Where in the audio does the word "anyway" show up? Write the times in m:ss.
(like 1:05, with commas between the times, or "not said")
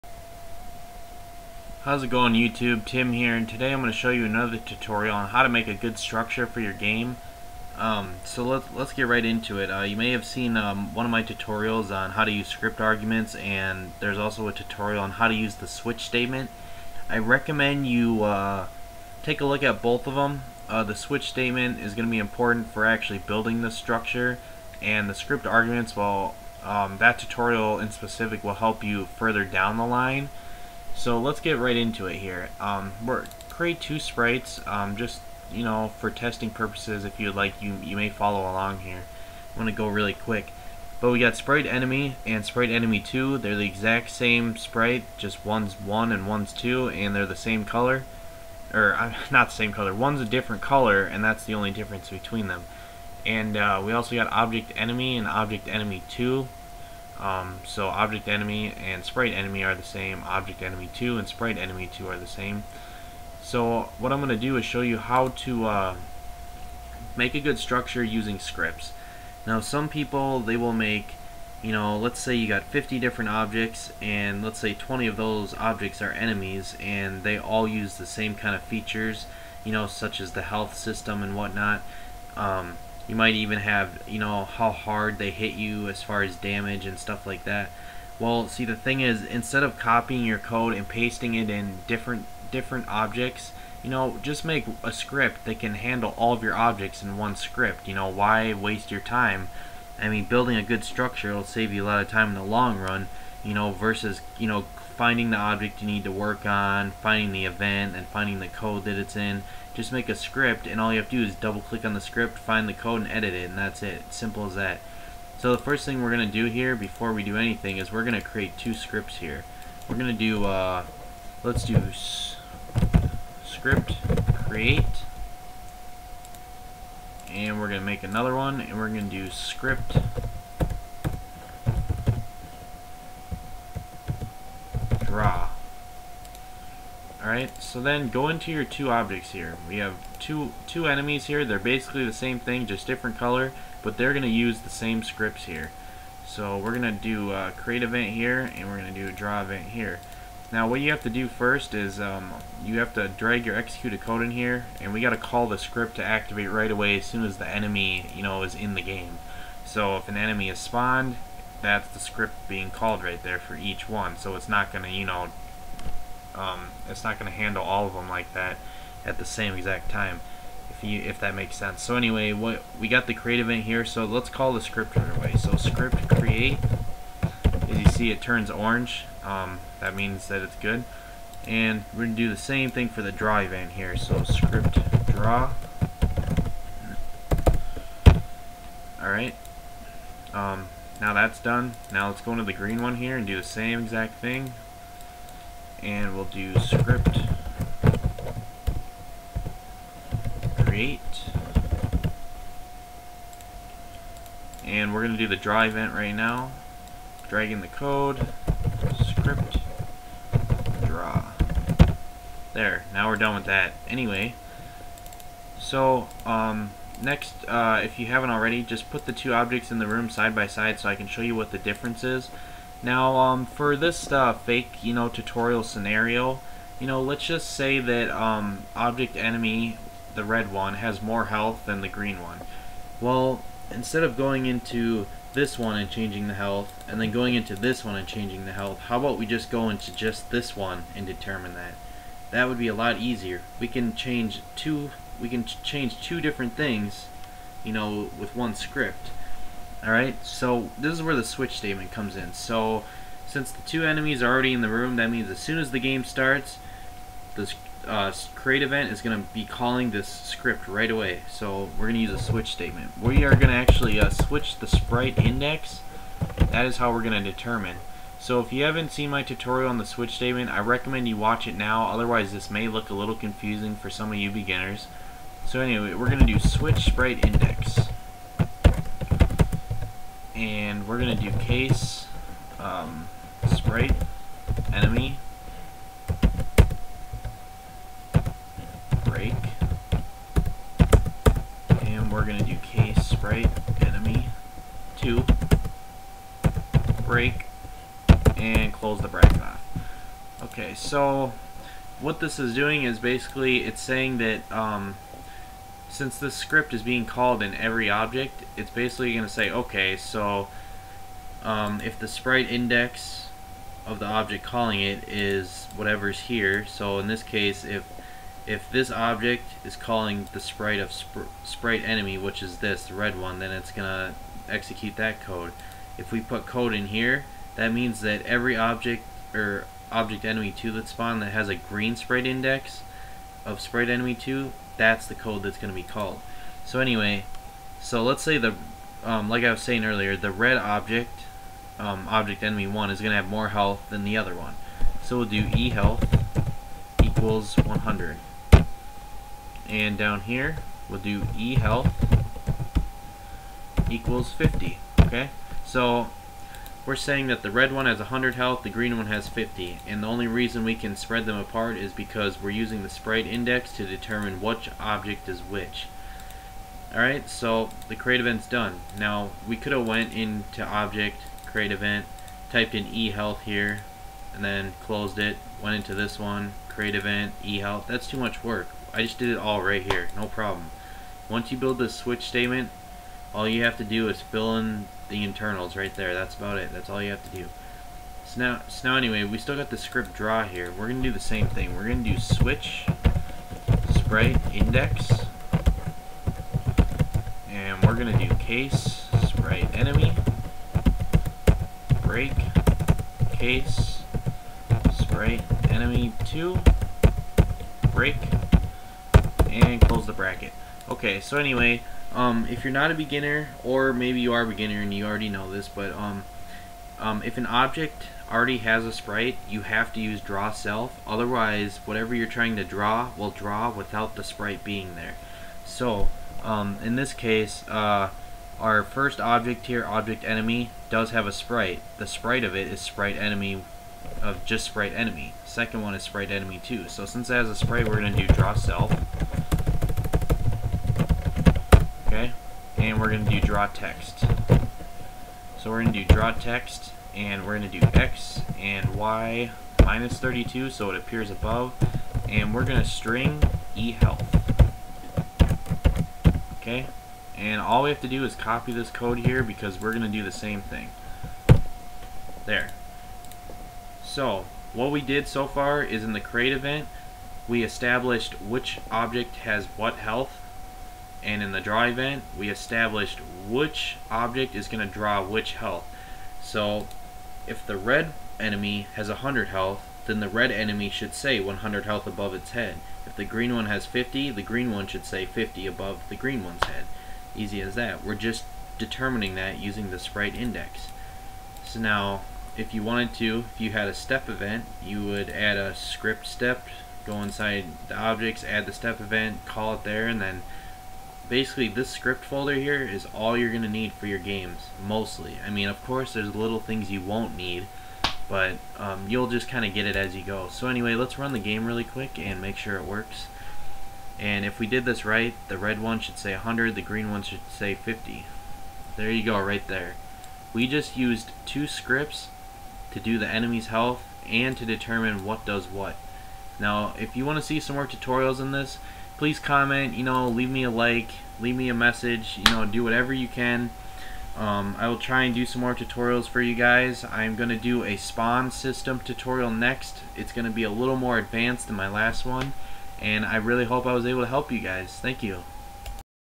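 2:51, 3:33, 4:35, 5:36, 6:28, 6:51, 8:30.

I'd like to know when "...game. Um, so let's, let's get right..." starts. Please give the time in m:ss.
0:06.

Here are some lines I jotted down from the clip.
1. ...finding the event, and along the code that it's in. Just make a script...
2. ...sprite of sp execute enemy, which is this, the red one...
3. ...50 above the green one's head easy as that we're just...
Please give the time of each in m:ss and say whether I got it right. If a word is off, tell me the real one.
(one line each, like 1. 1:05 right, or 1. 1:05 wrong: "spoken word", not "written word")
1. 1:47 wrong: "finding", not "along"
2. 5:20 wrong: "sprite", not "execute"
3. 8:05 right.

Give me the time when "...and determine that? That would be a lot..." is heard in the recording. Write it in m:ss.
4:00.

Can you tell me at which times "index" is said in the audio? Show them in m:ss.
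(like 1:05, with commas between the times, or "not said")
4:25, 4:37, 5:12, 5:32, 6:03, 6:34, 8:10.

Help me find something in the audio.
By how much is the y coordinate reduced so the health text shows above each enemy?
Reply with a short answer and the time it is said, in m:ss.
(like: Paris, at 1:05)
32, at 7:29.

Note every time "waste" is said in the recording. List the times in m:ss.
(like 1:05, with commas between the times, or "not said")
1:38.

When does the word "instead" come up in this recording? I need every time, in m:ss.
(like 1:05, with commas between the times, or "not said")
1:29, 3:53.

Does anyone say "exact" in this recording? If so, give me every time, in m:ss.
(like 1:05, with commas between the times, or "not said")
0:43, 2:49, 3:13.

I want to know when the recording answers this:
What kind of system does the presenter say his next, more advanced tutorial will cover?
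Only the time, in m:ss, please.
8:57.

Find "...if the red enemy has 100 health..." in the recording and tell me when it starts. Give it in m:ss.
7:57.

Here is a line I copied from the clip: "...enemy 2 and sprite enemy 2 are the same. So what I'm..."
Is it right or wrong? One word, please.
right.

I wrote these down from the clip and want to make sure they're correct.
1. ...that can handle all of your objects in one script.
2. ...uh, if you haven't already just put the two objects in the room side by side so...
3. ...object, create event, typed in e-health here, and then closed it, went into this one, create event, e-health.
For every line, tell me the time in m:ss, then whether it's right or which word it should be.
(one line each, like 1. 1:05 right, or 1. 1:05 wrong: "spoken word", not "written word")
1. 1:35 right
2. 3:37 right
3. 6:10 right.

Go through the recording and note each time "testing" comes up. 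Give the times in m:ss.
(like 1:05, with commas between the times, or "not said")
0:36.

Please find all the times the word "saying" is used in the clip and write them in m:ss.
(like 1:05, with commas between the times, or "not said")
5:03, 5:39, 5:56.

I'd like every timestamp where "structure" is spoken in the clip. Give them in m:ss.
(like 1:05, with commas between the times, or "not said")
0:05, 0:23, 1:07, 1:40.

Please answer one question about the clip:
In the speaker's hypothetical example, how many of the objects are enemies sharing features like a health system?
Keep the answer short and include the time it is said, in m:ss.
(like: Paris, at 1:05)
20, at 1:14.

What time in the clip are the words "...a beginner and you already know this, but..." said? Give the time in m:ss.
6:54.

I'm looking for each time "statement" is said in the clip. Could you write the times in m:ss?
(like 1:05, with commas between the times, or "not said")
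0:16, 0:21, 4:11, 4:22, 4:30, 6:22.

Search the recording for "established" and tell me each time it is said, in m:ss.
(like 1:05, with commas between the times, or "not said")
7:47, 7:52.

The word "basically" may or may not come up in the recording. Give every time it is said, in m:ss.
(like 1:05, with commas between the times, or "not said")
2:21, 5:02, 5:08, 8:21.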